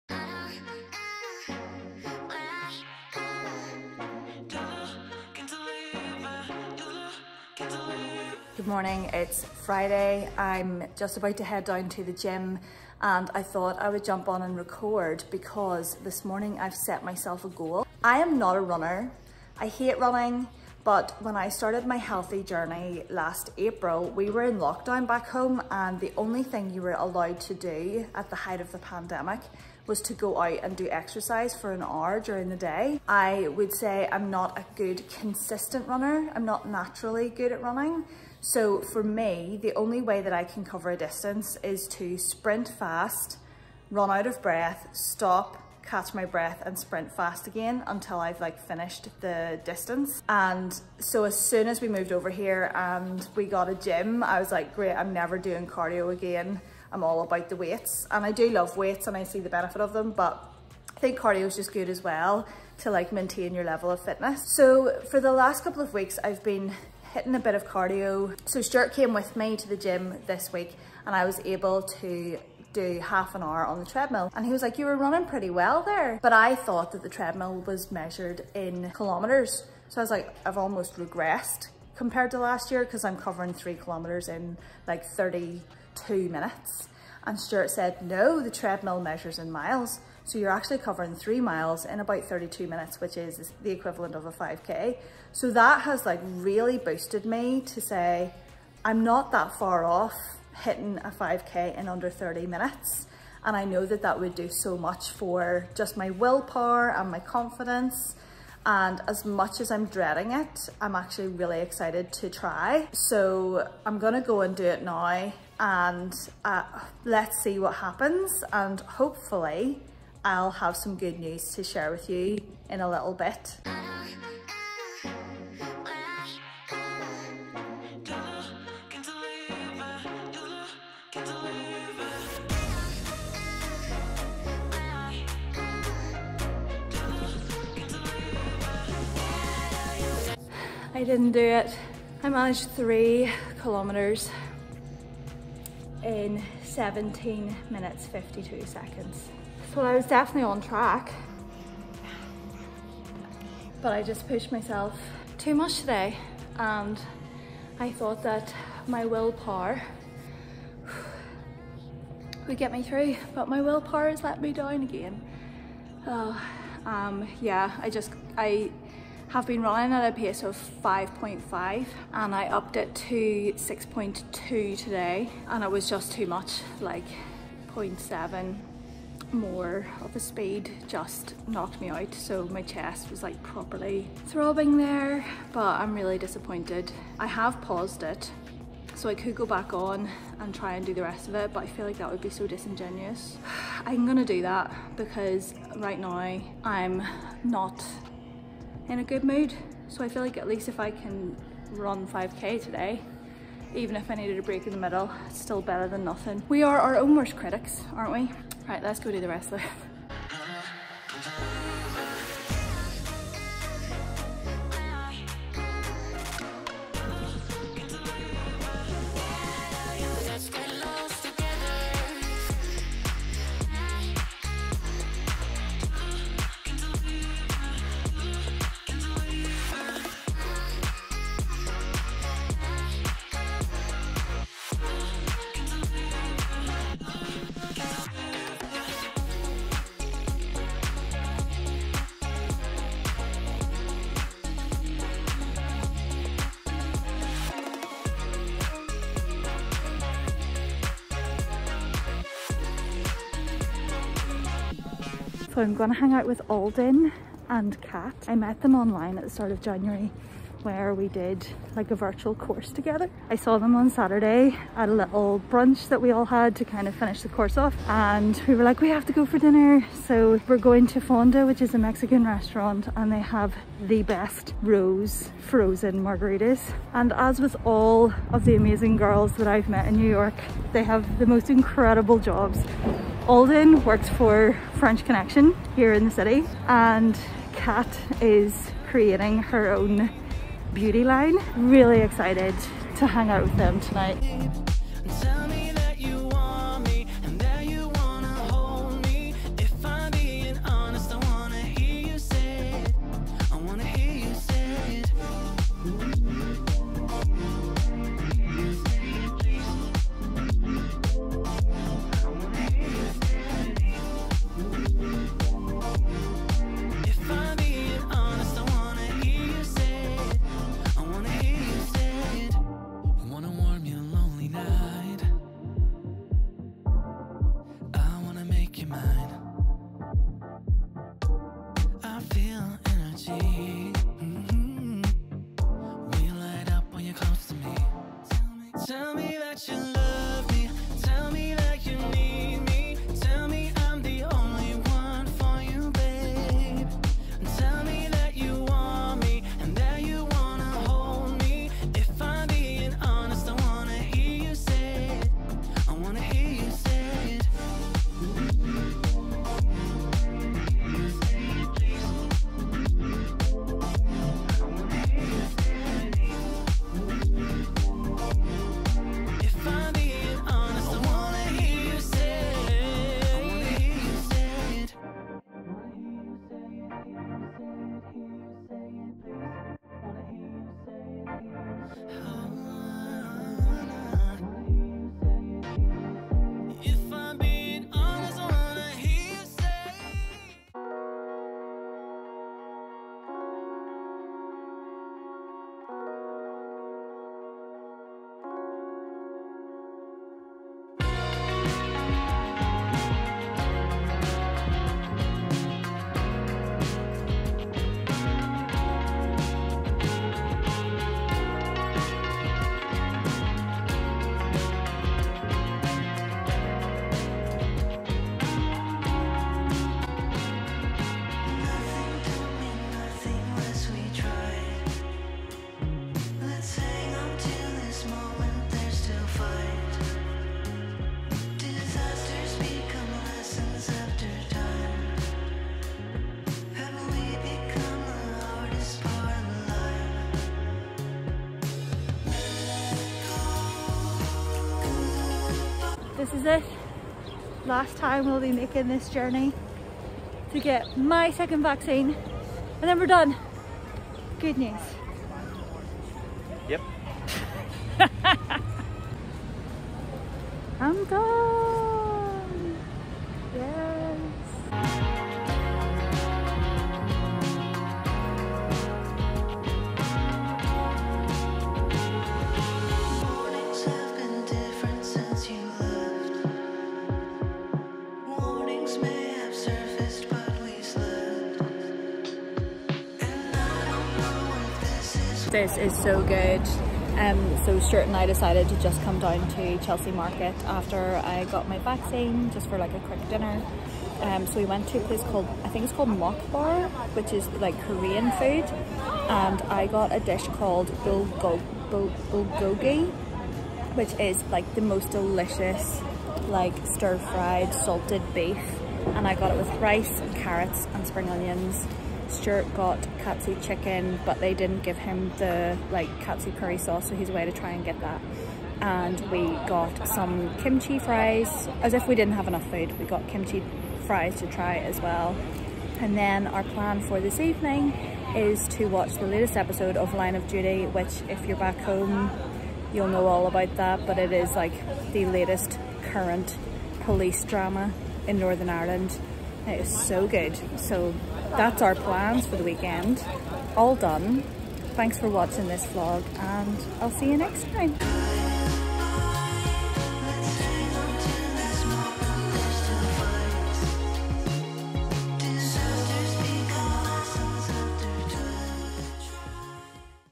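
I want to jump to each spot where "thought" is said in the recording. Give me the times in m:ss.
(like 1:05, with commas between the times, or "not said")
0:13, 1:16, 2:37.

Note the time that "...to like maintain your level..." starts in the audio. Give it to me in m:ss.
1:02.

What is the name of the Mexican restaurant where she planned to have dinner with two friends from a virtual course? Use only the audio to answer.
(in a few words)
Fonda.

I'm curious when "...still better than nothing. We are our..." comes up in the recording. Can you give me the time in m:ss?
3:25.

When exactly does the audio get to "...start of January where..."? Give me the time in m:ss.
4:19.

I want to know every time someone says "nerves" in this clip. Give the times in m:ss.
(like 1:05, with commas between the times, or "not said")
not said.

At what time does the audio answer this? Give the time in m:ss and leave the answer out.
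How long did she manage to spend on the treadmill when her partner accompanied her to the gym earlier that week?
1:12.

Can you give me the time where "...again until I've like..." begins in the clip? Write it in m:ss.
0:47.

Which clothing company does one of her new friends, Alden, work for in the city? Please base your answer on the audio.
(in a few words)
French Connection.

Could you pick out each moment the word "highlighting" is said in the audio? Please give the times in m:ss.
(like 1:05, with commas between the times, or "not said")
not said.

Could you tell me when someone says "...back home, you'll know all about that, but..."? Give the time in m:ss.
8:51.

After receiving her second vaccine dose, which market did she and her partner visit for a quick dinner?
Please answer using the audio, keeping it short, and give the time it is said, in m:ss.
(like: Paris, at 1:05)
Chelsea Market, at 8:09.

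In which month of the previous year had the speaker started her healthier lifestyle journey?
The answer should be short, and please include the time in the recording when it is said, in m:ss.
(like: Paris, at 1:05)
April, at 0:23.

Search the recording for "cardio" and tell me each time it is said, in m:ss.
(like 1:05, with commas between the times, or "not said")
0:55, 1:01, 1:07.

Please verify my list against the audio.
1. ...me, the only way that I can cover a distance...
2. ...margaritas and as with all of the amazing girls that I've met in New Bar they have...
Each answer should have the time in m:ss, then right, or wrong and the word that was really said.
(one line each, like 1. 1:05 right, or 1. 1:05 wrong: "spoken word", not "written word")
1. 0:39 right
2. 4:36 wrong: "York", not "Bar".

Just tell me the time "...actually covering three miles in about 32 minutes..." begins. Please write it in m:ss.
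1:30.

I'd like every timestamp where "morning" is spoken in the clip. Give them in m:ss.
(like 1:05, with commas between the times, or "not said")
0:08, 0:16.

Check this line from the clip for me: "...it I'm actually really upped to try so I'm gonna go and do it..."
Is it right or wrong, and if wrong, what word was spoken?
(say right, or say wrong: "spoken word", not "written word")
wrong: "excited", not "upped".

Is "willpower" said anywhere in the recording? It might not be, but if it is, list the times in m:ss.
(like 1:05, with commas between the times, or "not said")
1:46, 2:39, 2:43.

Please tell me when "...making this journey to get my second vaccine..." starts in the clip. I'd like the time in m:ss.
7:28.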